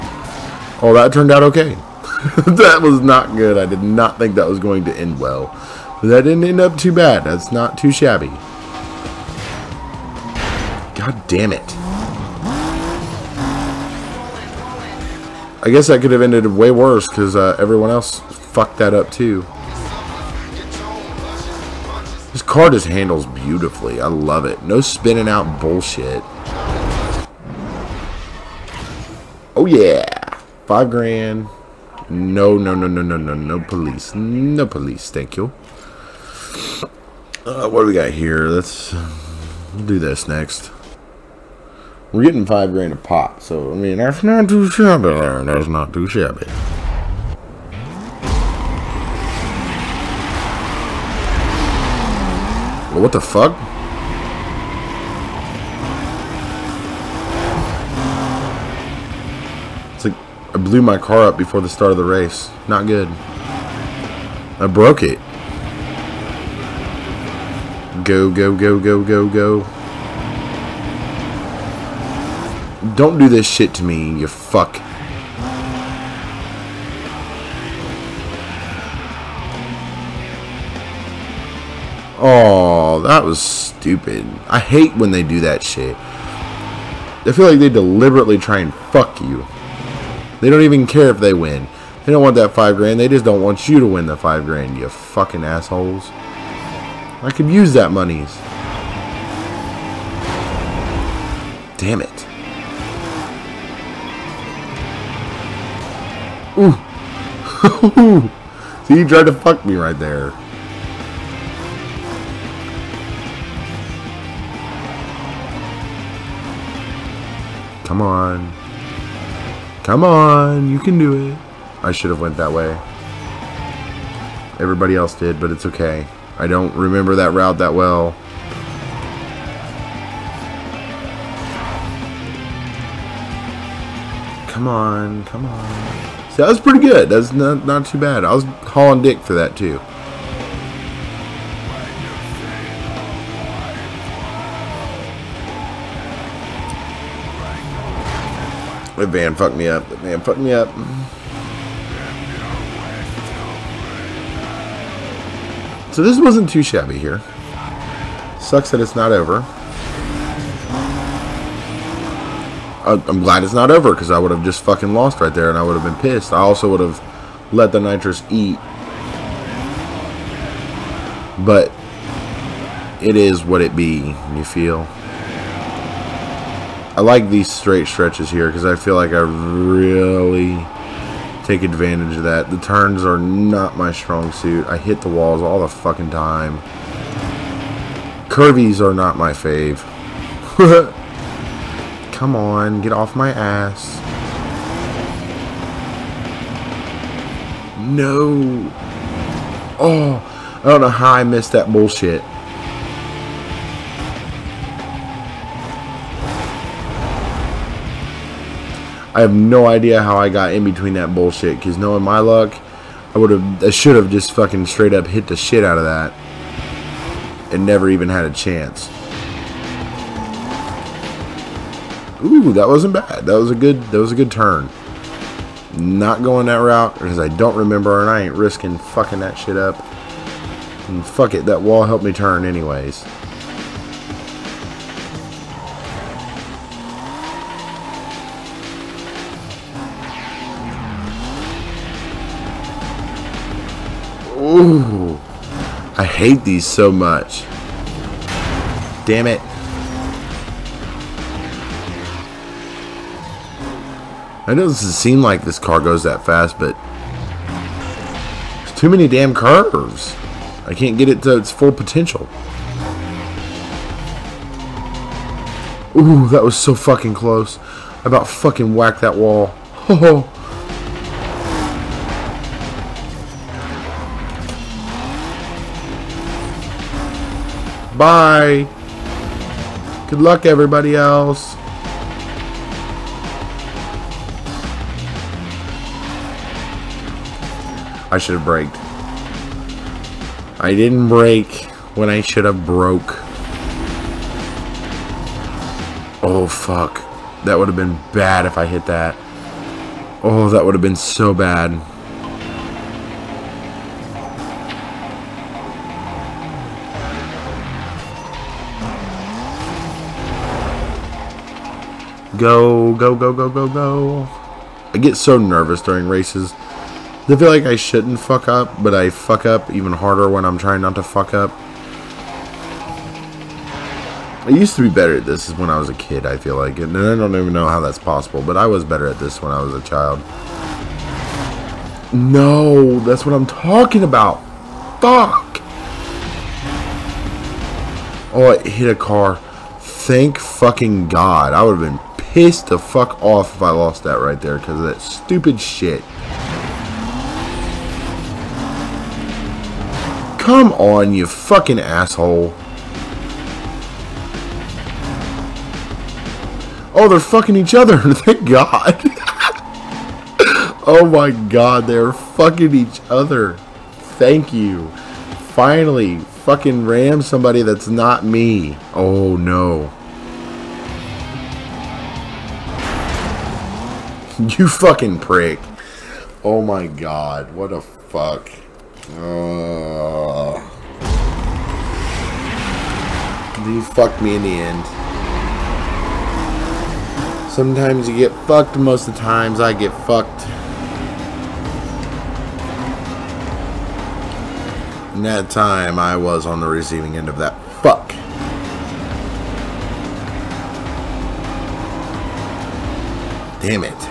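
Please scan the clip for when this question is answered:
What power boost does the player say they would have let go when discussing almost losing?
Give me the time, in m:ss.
2:47.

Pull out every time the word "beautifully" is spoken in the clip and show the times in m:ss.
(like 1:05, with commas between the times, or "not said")
0:23.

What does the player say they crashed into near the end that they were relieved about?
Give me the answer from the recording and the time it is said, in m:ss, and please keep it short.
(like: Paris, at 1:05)
a car, at 5:38.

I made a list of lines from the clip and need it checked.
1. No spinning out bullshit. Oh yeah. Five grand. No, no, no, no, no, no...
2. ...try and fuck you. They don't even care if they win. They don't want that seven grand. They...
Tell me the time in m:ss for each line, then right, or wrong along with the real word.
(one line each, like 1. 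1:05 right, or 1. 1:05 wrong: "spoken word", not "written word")
1. 0:24 right
2. 1:28 wrong: "five", not "seven".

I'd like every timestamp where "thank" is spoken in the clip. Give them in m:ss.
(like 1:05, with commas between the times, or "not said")
0:35, 5:39, 5:57, 6:04.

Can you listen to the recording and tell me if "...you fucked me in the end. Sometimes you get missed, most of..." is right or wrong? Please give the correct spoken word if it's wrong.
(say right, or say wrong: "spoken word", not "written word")
wrong: "fucked", not "missed".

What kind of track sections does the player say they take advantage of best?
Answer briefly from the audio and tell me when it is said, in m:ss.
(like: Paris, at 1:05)
straight stretches, at 2:57.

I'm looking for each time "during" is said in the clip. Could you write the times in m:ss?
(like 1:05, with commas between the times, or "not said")
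5:15.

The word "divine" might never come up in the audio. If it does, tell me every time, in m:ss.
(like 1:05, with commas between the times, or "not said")
not said.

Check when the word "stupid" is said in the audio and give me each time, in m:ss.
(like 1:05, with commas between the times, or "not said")
1:23, 5:45.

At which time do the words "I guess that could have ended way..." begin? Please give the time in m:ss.
0:15.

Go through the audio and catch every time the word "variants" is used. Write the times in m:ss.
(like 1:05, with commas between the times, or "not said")
not said.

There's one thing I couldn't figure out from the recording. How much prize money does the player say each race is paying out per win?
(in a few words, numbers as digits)
5 grand.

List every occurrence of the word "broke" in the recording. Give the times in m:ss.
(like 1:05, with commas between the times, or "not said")
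1:04, 4:52.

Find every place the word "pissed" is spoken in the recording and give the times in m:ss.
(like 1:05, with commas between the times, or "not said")
2:46, 5:42.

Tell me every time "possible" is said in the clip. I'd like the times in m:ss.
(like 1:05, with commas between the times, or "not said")
5:27.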